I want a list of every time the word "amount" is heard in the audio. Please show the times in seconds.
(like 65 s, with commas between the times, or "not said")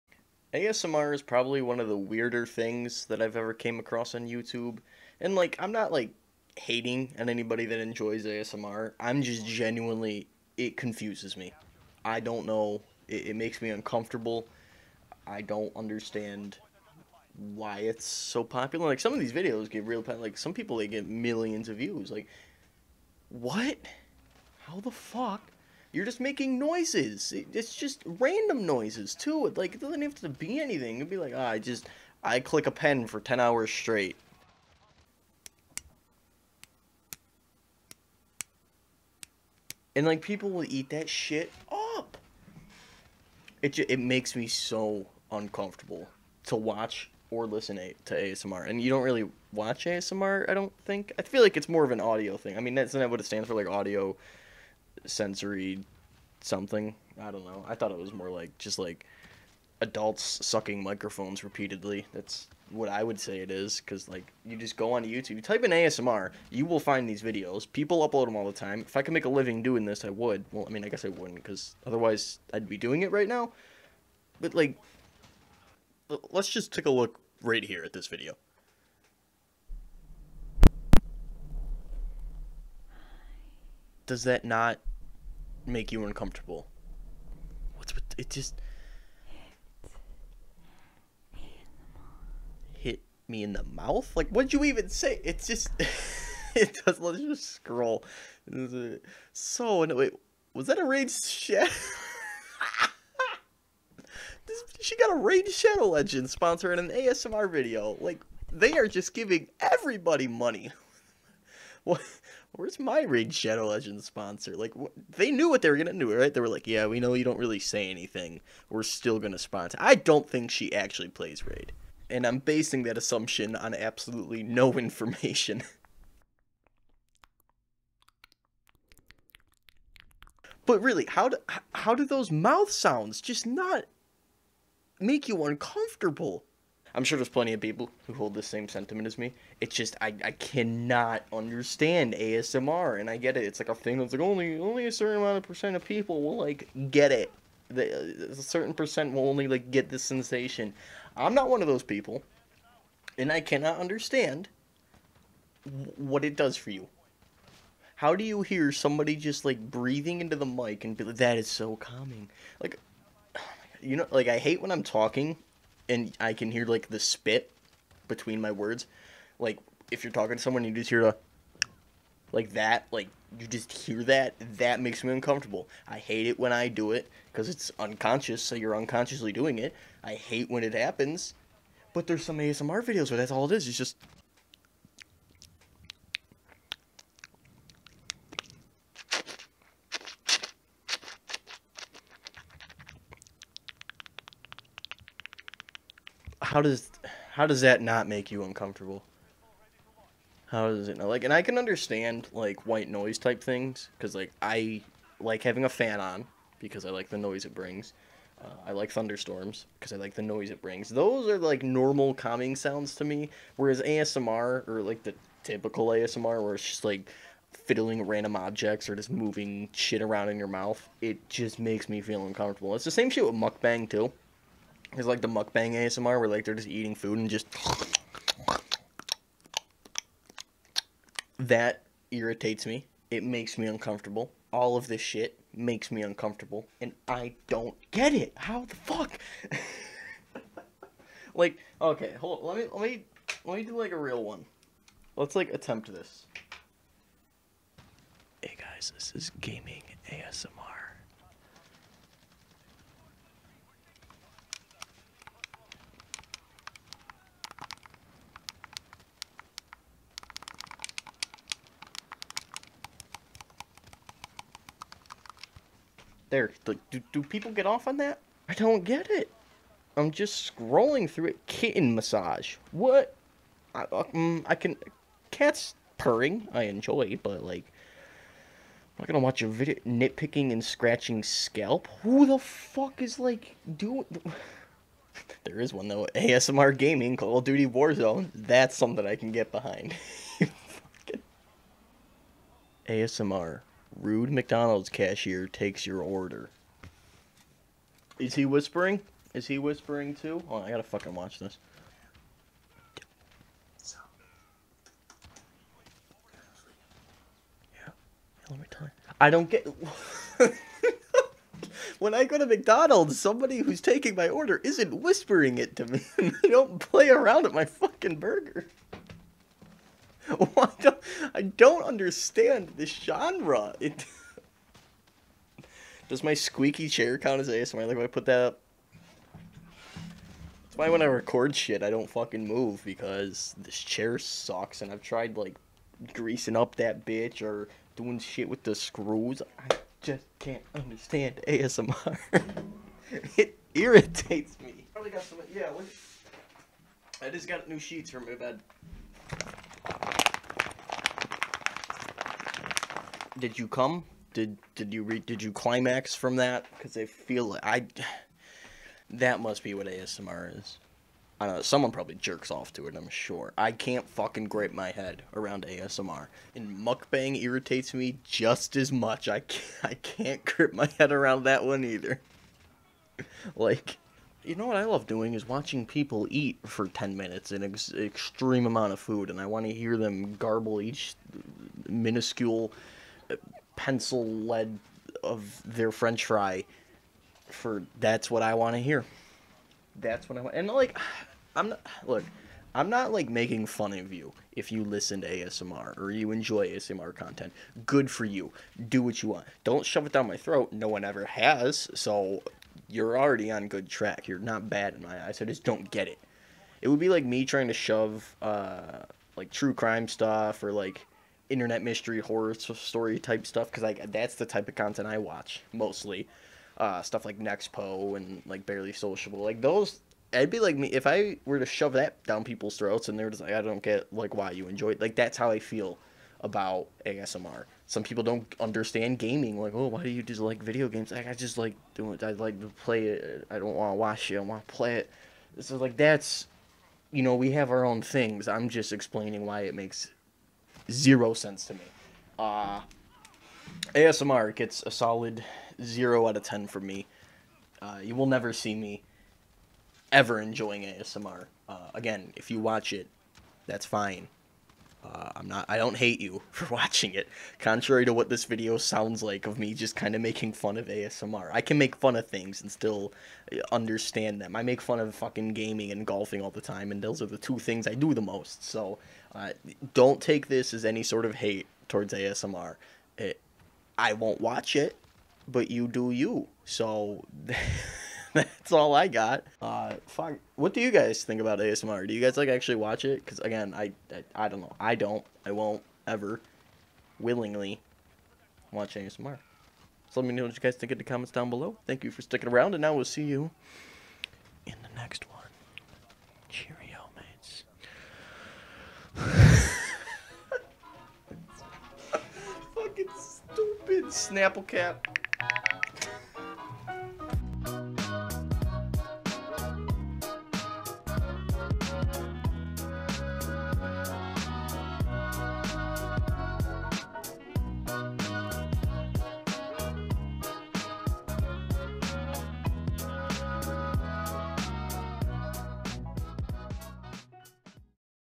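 145 s, 378 s.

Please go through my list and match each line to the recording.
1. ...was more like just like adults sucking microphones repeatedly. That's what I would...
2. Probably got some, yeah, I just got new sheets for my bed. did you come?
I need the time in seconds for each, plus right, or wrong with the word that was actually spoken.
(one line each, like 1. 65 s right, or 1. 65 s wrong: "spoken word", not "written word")
1. 57 s right
2. 344 s right.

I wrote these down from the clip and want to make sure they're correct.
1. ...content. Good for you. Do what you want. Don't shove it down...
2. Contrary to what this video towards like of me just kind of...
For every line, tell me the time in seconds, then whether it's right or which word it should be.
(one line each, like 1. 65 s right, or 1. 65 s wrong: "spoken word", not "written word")
1. 397 s right
2. 457 s wrong: "sounds", not "towards".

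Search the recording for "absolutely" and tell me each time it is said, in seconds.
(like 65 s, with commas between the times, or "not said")
123 s.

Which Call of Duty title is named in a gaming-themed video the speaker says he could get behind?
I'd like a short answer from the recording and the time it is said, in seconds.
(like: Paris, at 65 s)
Warzone, at 287 s.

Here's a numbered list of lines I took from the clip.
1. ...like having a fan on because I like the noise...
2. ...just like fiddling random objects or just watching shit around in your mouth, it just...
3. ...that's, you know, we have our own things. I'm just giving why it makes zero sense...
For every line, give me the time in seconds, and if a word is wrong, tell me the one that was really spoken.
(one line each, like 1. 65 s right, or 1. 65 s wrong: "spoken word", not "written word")
1. 205 s right
2. 216 s wrong: "moving", not "watching"
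3. 435 s wrong: "explaining", not "giving".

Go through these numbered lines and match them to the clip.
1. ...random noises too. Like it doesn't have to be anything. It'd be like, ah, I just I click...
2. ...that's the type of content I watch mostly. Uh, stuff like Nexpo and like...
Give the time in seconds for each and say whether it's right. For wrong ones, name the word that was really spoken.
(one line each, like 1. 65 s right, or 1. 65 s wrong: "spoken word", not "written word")
1. 28 s right
2. 414 s right.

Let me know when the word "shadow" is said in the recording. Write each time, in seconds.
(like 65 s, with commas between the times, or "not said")
101 s, 105 s, 113 s.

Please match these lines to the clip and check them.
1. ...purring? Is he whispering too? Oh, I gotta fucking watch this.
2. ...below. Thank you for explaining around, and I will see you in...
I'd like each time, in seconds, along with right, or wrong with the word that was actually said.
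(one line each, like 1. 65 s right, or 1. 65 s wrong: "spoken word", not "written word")
1. 298 s wrong: "whispering", not "purring"
2. 491 s wrong: "sticking", not "explaining".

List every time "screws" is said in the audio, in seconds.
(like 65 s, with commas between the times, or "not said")
338 s.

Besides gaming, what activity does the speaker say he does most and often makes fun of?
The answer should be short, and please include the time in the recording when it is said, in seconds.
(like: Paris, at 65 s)
Golfing, at 466 s.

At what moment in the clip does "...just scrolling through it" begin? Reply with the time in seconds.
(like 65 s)
270 s.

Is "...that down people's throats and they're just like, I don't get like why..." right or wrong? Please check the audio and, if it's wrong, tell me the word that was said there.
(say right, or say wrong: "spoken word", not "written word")
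right.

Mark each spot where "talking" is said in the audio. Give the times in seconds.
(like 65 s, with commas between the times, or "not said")
164 s, 170 s.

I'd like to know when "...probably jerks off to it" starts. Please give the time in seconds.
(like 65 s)
361 s.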